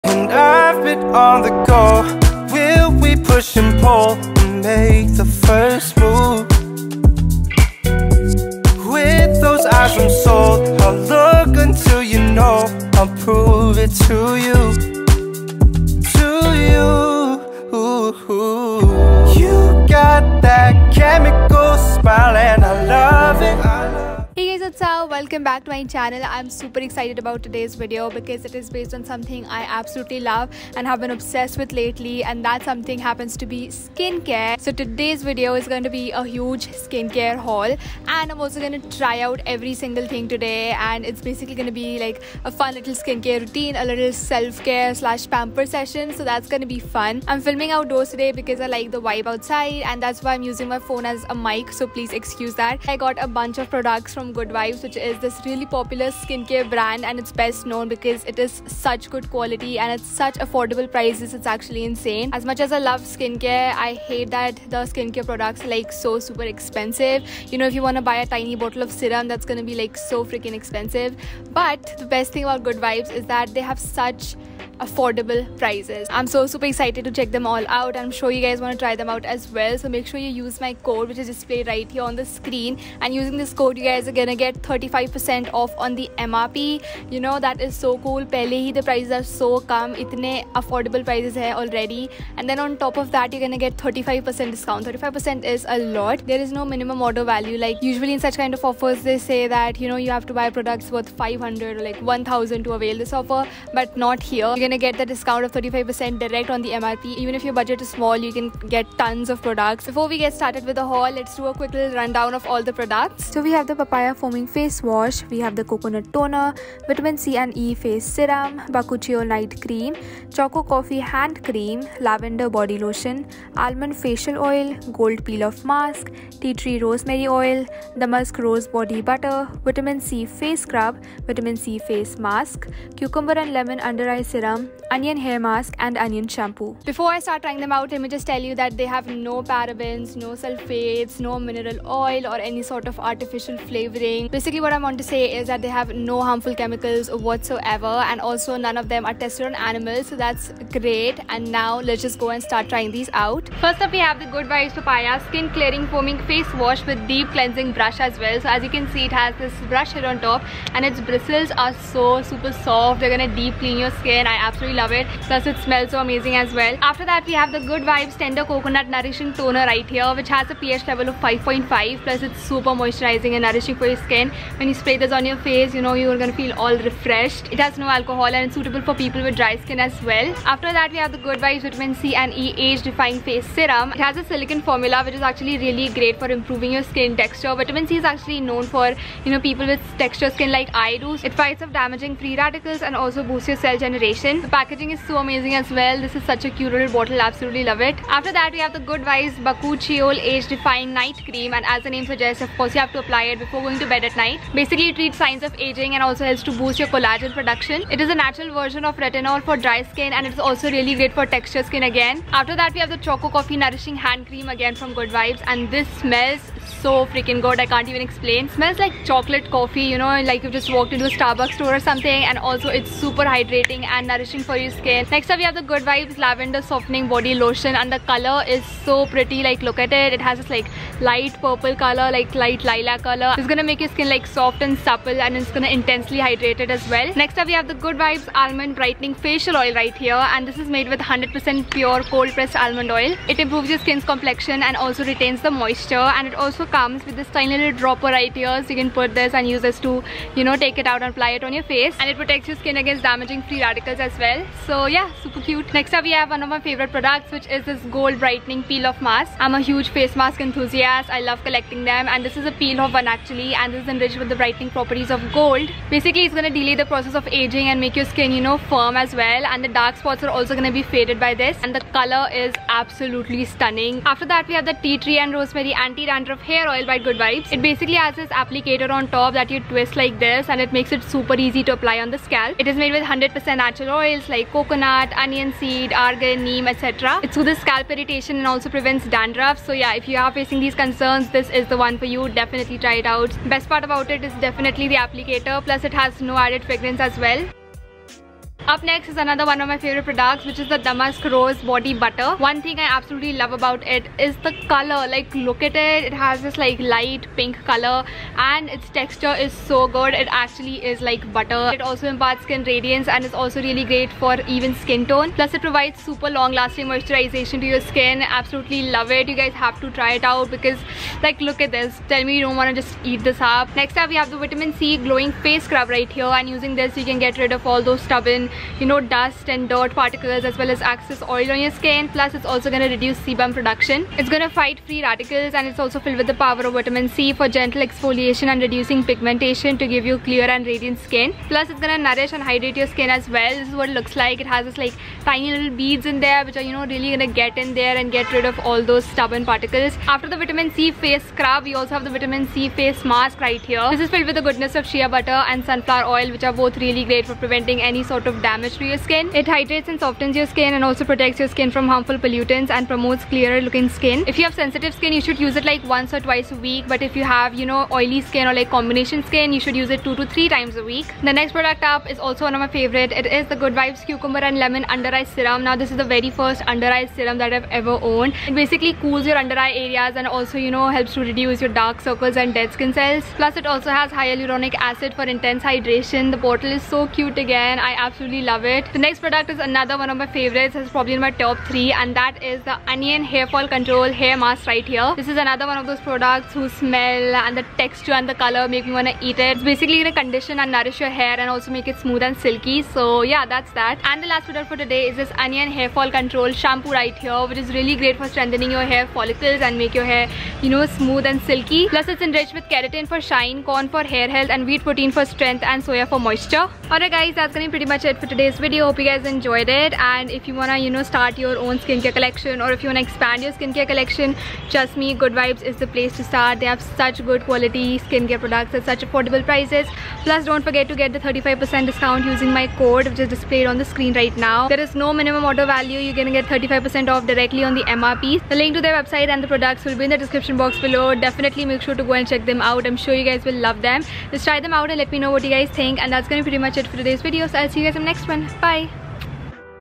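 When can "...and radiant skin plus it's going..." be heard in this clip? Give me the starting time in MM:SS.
05:40.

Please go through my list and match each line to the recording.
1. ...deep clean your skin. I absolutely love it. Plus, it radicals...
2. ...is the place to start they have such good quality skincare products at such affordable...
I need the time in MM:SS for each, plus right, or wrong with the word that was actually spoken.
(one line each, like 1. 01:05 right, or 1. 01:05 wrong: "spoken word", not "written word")
1. 02:43 wrong: "smells", not "radicals"
2. 07:05 right.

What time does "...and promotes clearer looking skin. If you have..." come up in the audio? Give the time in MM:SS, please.
06:02.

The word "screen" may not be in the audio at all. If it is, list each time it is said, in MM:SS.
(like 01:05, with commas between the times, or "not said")
01:22, 07:13.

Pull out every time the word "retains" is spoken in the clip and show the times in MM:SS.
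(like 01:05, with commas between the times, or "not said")
04:05.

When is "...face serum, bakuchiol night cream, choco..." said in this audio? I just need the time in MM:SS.
01:57.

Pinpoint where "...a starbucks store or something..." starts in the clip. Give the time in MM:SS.
03:41.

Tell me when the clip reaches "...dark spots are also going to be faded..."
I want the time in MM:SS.
04:29.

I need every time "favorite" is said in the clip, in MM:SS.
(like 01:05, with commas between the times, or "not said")
04:16, 04:59, 06:12, 06:30.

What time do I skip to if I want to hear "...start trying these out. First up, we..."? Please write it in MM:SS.
02:32.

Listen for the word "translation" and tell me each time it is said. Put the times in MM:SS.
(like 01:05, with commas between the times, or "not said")
not said.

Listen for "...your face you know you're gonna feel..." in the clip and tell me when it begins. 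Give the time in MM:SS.
02:55.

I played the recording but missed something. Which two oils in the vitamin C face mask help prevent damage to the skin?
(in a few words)
Shea butter and sunflower oil.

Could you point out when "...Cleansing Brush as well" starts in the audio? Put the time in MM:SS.
02:37.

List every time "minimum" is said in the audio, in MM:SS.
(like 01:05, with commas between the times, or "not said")
01:36, 07:15.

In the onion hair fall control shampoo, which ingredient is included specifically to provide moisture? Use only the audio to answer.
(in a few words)
Soya.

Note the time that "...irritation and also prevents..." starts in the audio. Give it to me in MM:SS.
04:47.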